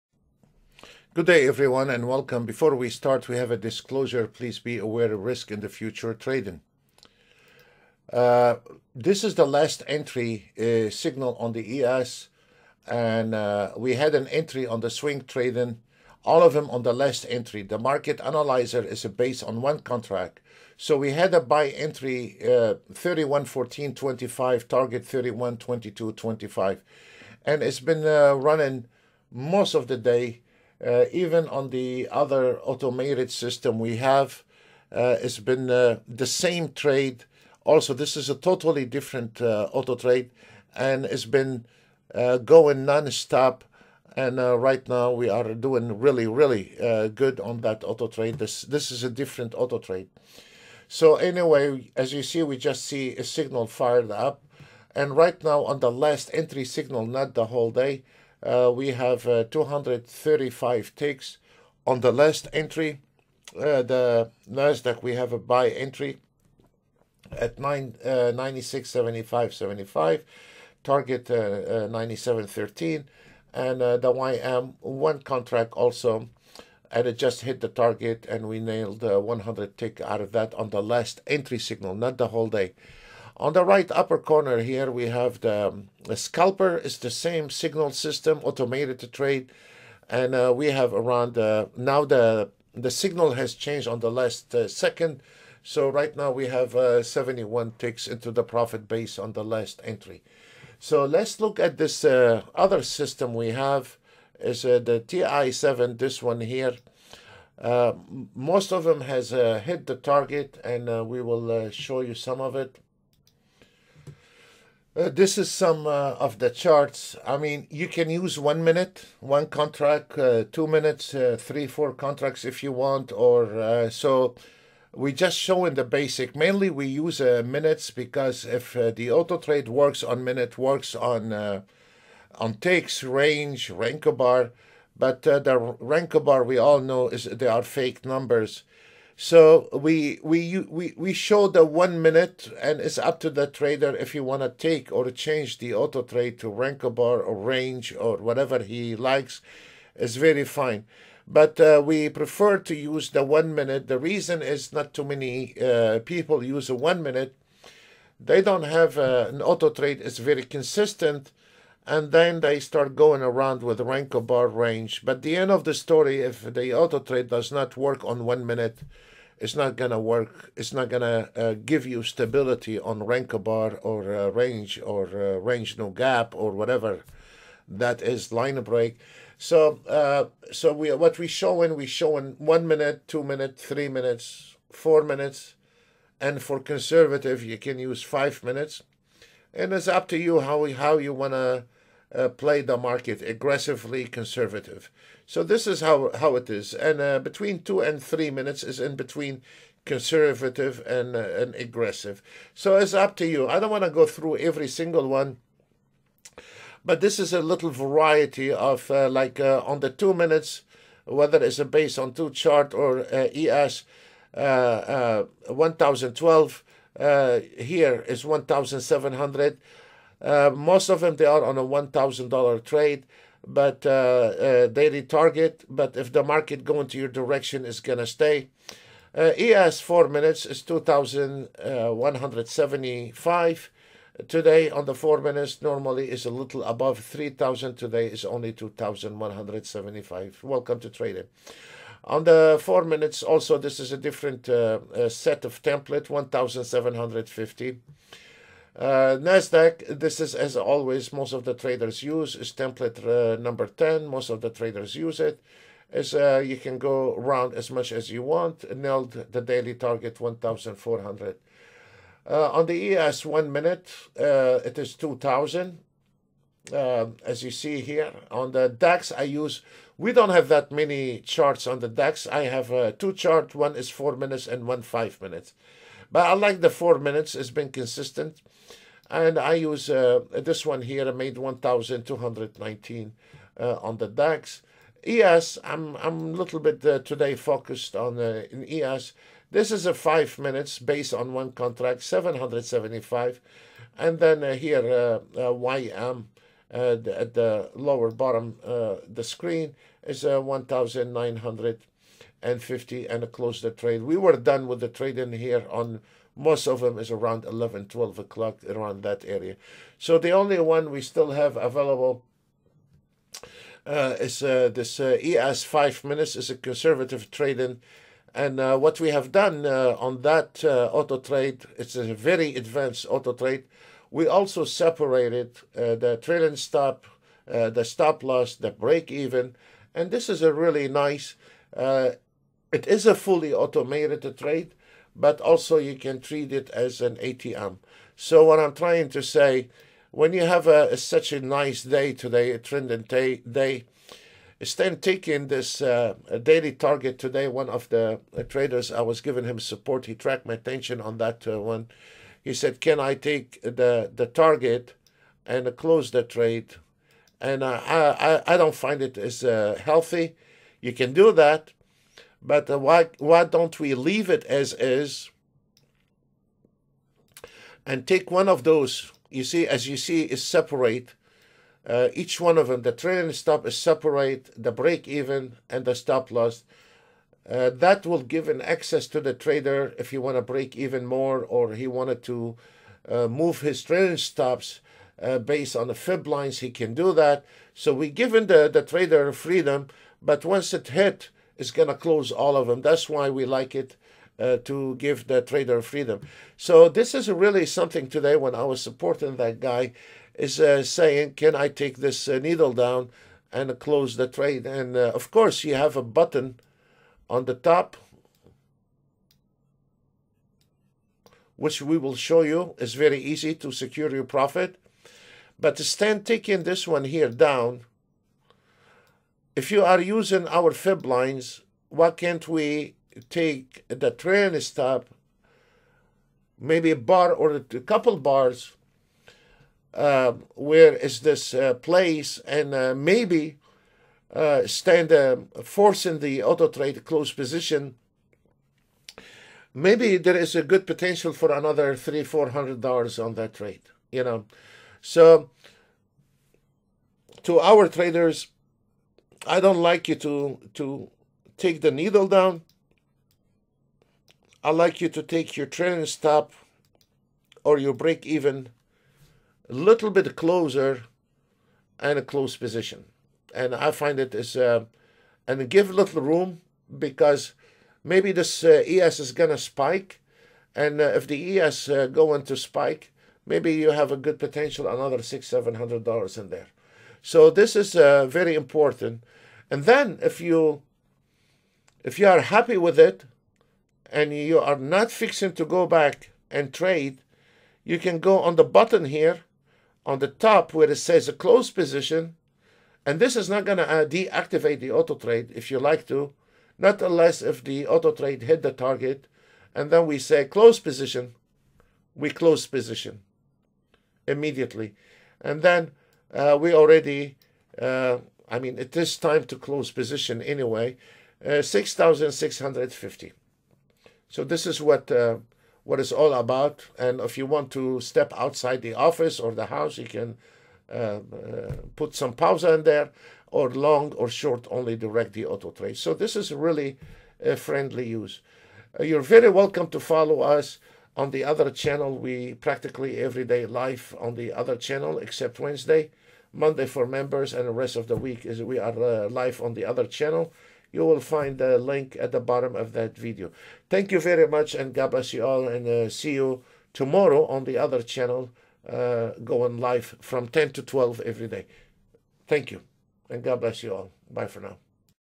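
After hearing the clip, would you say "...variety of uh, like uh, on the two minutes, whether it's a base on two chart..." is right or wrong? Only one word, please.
right.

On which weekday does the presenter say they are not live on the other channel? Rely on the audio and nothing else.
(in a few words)
Wednesday.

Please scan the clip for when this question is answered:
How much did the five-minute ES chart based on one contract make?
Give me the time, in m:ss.
4:52.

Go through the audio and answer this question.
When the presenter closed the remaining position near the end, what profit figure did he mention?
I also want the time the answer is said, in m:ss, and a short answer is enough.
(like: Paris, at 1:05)
6,650, at 8:31.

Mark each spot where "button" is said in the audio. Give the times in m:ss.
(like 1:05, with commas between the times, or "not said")
6:46, 8:08.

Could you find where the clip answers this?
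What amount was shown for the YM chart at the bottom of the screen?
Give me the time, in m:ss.
5:00.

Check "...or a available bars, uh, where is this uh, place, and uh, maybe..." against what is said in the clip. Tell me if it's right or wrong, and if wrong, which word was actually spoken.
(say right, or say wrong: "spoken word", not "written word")
wrong: "couple", not "available".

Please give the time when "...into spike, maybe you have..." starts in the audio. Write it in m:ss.
7:52.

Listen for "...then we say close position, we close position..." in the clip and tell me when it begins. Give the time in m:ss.
8:19.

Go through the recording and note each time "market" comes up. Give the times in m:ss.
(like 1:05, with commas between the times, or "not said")
0:17, 3:12, 3:46.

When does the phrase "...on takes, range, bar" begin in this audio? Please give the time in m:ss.
2:12.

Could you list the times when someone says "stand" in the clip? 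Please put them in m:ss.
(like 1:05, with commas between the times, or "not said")
6:55, 7:14.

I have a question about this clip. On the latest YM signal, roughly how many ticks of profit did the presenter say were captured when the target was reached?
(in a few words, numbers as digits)
100.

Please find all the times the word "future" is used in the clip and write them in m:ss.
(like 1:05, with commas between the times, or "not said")
0:05.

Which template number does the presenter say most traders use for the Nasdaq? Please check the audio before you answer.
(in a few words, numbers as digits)
10.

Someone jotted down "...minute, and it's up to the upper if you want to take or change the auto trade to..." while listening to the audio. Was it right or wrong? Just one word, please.
wrong.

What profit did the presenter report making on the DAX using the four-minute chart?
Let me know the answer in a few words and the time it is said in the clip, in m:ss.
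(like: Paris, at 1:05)
1,219, at 4:41.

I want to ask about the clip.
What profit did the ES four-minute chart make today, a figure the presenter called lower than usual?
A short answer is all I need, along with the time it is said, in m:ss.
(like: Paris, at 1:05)
$2,175, at 3:50.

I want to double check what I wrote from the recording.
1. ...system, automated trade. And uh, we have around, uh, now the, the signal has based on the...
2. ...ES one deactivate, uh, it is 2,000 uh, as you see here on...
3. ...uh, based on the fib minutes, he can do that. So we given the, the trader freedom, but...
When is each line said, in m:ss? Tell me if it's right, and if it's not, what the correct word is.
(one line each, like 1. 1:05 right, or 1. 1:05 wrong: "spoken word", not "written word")
1. 1:27 wrong: "changed", not "based"
2. 4:22 wrong: "minute", not "deactivate"
3. 6:25 wrong: "lines", not "minutes".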